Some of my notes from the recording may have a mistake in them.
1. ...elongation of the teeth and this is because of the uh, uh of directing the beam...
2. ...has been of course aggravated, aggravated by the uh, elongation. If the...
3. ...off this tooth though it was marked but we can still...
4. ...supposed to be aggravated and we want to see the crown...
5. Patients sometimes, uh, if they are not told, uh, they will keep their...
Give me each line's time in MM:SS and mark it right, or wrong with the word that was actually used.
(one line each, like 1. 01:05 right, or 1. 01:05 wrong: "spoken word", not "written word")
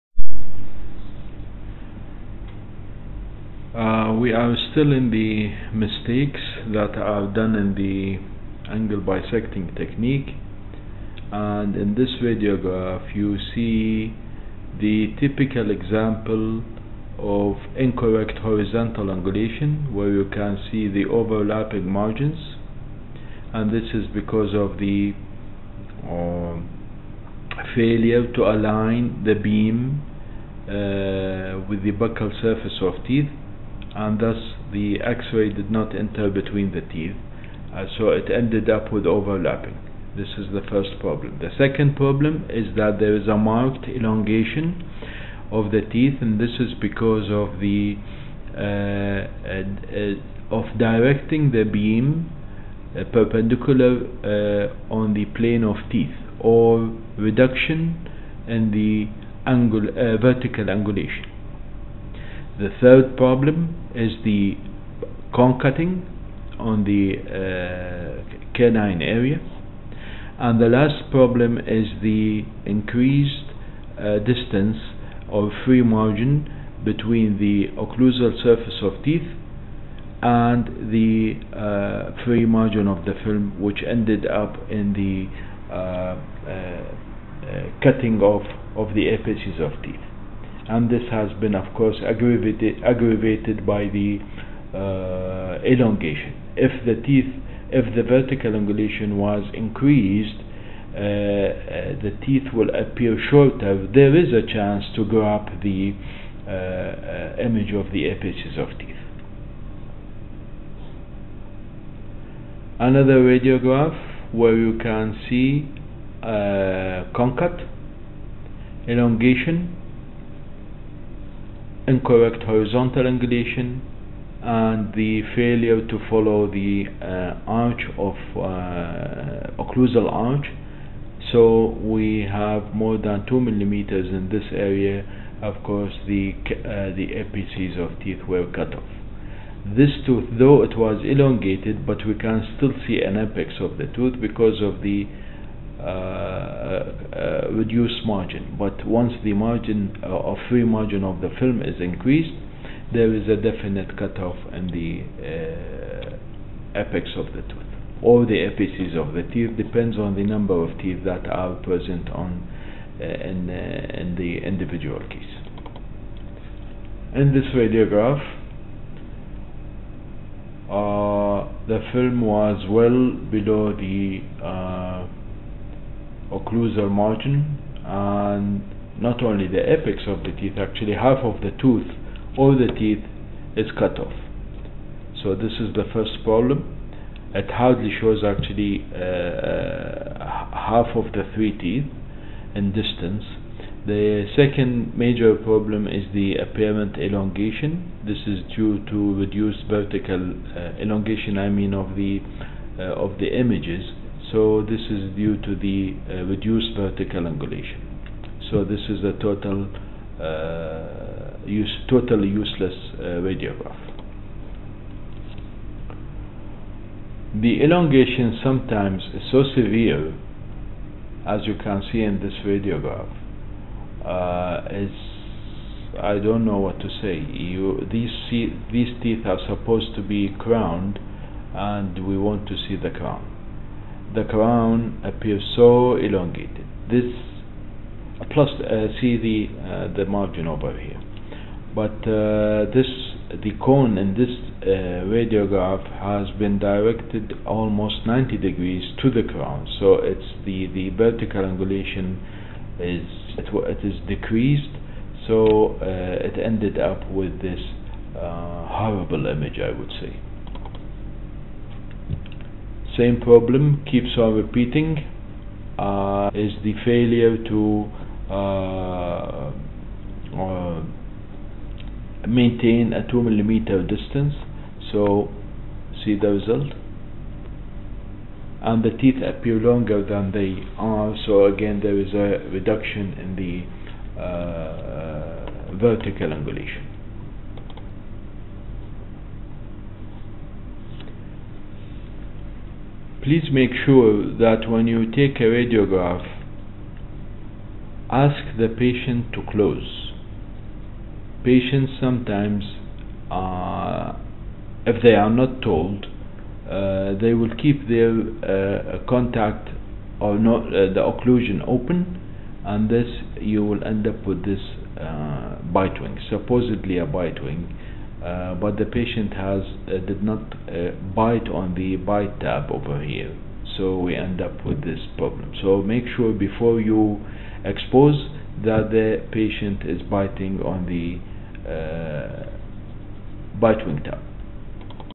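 1. 00:43 right
2. 01:31 right
3. 02:18 wrong: "elongated", not "marked"
4. 03:49 wrong: "crowned", not "aggravated"
5. 05:01 right.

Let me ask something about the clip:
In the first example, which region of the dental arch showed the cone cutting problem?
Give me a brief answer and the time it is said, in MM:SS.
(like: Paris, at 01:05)
canine area, at 01:08.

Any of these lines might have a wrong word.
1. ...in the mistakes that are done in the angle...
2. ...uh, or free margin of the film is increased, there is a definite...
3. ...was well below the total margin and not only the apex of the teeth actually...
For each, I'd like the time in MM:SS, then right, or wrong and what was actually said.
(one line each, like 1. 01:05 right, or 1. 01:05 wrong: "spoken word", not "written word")
1. 00:04 right
2. 02:30 right
3. 02:52 wrong: "occlusal", not "total".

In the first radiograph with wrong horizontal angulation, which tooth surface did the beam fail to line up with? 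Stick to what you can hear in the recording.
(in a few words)
buccal surface.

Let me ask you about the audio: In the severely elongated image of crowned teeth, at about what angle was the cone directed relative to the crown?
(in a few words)
90 degrees.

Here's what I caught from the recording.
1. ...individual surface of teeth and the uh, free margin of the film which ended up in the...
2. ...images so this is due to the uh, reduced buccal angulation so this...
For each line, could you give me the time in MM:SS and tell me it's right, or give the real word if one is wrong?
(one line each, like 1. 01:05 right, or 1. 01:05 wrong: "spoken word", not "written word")
1. 01:17 wrong: "occlusal", not "individual"
2. 03:23 wrong: "vertical", not "buccal".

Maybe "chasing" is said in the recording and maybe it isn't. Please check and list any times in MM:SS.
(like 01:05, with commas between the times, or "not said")
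not said.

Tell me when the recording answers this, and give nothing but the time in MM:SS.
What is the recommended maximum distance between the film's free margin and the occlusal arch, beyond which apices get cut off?
02:13.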